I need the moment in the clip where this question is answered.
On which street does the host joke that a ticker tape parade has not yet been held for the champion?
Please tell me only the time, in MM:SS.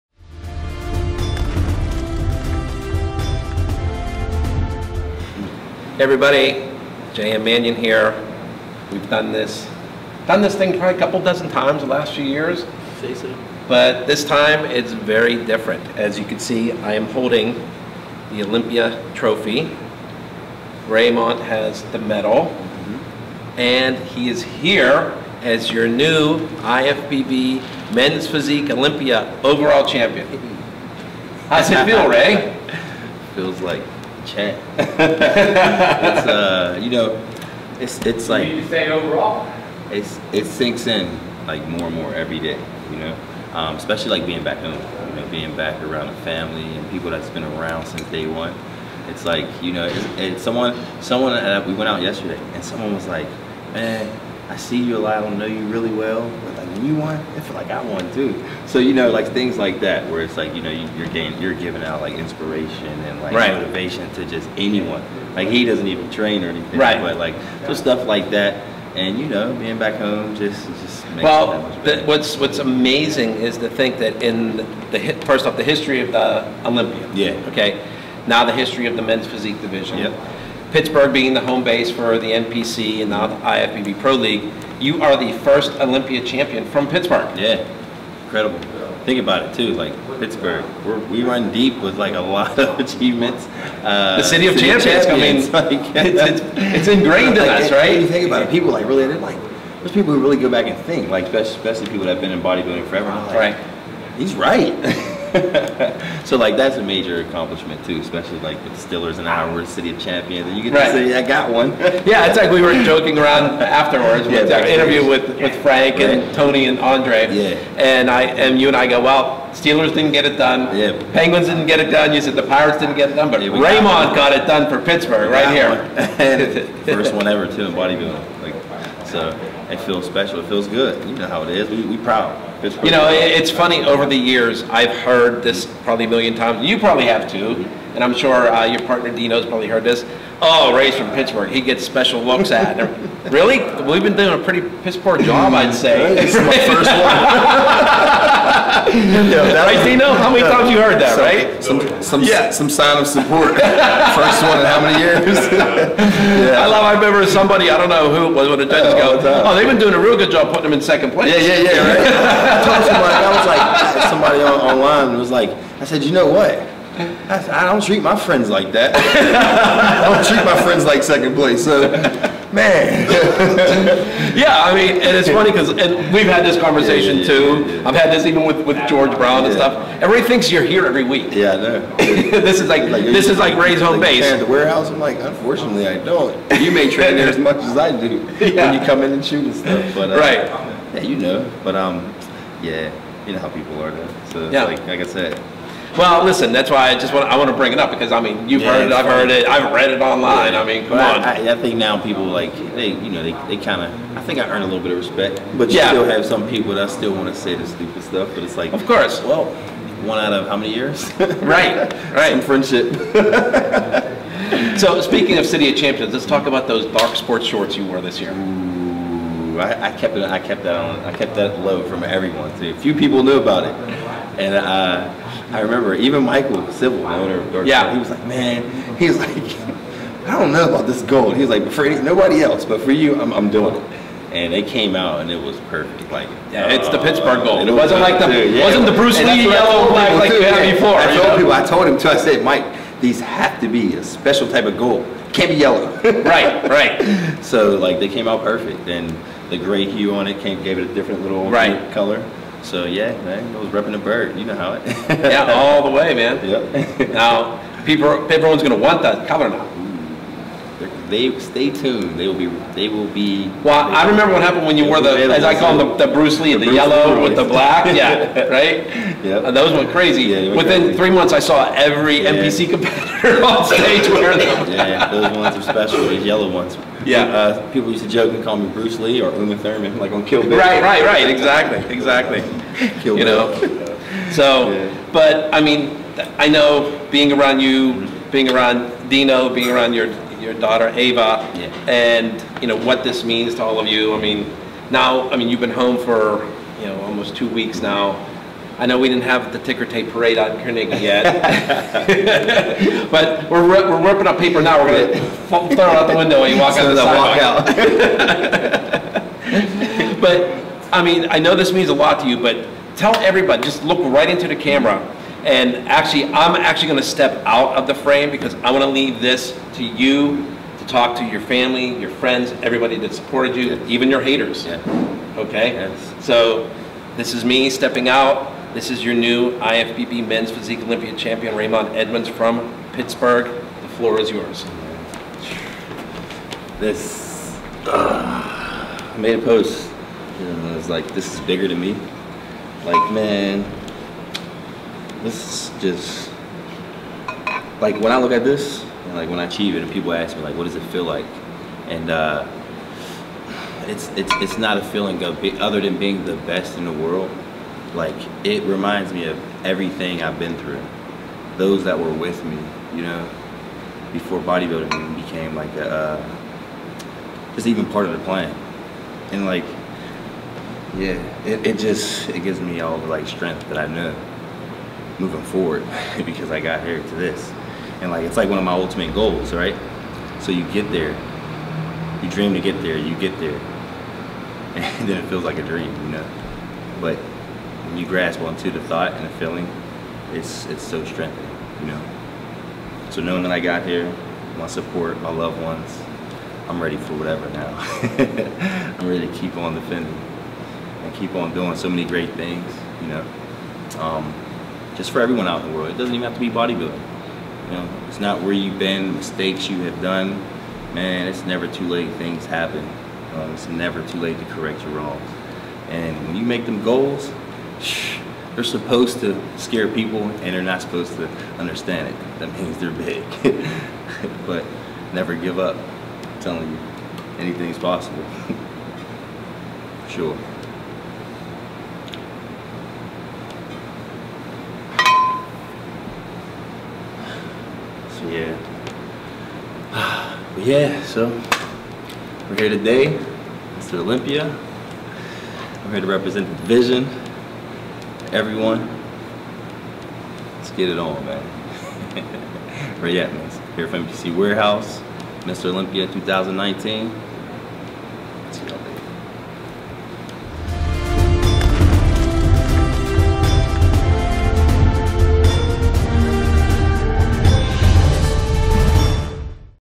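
05:00.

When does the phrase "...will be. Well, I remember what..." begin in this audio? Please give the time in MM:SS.
04:22.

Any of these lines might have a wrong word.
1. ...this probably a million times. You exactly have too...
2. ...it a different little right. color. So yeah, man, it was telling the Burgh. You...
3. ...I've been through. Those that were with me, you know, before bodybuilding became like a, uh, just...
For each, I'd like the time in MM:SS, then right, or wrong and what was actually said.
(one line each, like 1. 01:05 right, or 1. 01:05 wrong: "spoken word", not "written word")
1. 02:15 wrong: "probably", not "exactly"
2. 04:10 wrong: "repping", not "telling"
3. 06:00 right.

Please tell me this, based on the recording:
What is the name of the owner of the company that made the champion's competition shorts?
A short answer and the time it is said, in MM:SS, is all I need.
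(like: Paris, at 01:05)
Michael Civil, at 03:46.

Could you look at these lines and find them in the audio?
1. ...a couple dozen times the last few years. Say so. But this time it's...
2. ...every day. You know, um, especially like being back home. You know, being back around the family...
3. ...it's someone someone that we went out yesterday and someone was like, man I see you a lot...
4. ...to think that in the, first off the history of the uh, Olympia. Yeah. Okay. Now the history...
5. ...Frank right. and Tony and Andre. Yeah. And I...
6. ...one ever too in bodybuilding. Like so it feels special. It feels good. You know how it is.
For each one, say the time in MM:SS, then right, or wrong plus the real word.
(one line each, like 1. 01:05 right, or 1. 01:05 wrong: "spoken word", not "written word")
1. 00:10 right
2. 00:42 right
3. 00:50 right
4. 01:13 right
5. 01:55 right
6. 02:07 right.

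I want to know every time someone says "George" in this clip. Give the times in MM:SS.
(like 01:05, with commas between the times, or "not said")
02:58.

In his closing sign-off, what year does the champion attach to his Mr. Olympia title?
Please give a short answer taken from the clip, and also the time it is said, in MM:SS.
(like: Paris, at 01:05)
2019, at 07:35.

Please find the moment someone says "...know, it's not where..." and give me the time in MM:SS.
06:47.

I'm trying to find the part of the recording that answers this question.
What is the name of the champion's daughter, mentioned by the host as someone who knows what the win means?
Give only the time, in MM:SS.
04:50.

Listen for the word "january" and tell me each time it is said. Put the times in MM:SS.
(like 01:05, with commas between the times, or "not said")
not said.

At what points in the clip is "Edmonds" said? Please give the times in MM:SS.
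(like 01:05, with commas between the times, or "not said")
05:31, 07:33.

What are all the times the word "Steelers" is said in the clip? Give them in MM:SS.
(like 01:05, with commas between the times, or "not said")
01:48, 01:59.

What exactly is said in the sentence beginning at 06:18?
And like, it's like one of my ultimate goals, right?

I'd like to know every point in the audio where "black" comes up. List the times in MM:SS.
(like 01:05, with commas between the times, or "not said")
03:59, 04:27.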